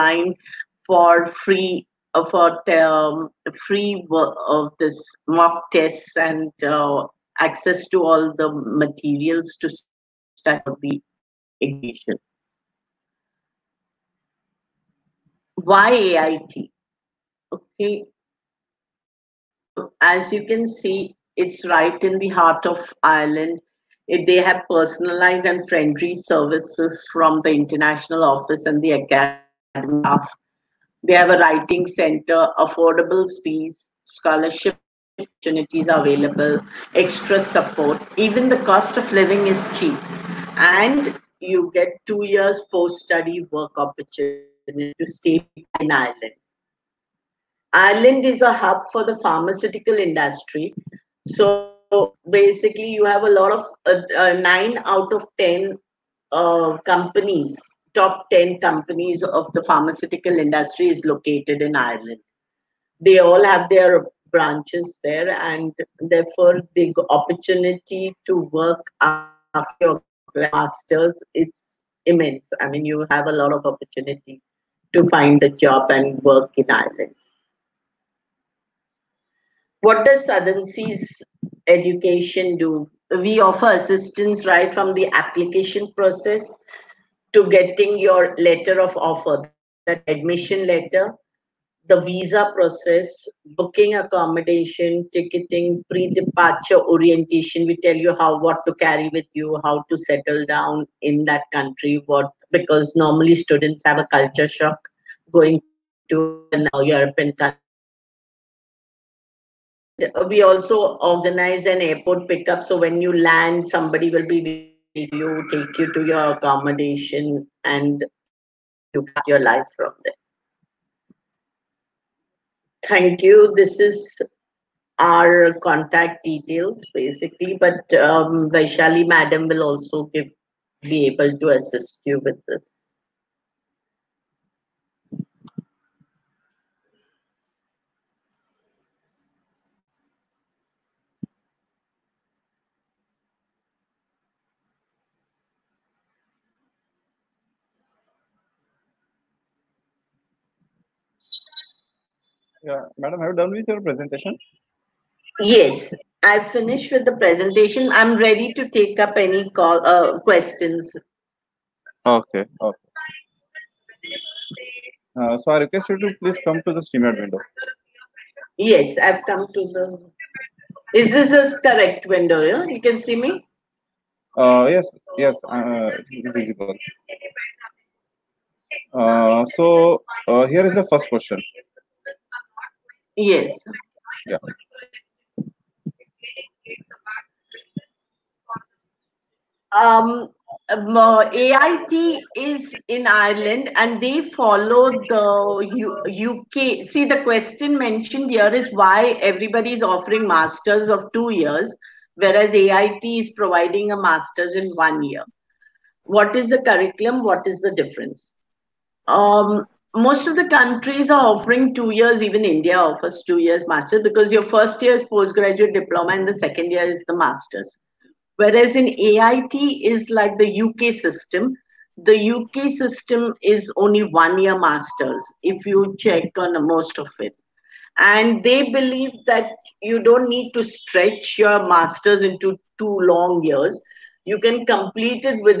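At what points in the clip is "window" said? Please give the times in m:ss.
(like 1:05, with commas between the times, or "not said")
2:47, 2:52.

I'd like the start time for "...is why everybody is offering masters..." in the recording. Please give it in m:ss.
3:18.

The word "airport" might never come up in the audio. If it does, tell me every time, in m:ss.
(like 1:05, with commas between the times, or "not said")
1:51.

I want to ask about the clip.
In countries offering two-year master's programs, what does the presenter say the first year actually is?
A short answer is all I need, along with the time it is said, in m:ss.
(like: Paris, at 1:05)
postgraduate diploma, at 3:35.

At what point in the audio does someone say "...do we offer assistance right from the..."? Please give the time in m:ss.
1:22.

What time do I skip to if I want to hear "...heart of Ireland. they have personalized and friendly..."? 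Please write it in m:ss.
0:22.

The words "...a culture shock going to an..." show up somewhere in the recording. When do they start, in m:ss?
1:43.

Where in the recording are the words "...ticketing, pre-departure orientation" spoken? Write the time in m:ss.
1:35.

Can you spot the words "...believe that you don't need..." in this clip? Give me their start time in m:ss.
3:48.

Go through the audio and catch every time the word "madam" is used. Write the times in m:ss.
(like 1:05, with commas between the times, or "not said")
2:09, 2:32.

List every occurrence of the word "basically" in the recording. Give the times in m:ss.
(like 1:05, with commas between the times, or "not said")
0:52, 2:06.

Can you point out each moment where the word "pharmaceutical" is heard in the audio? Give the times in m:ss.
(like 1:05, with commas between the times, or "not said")
0:49, 0:59.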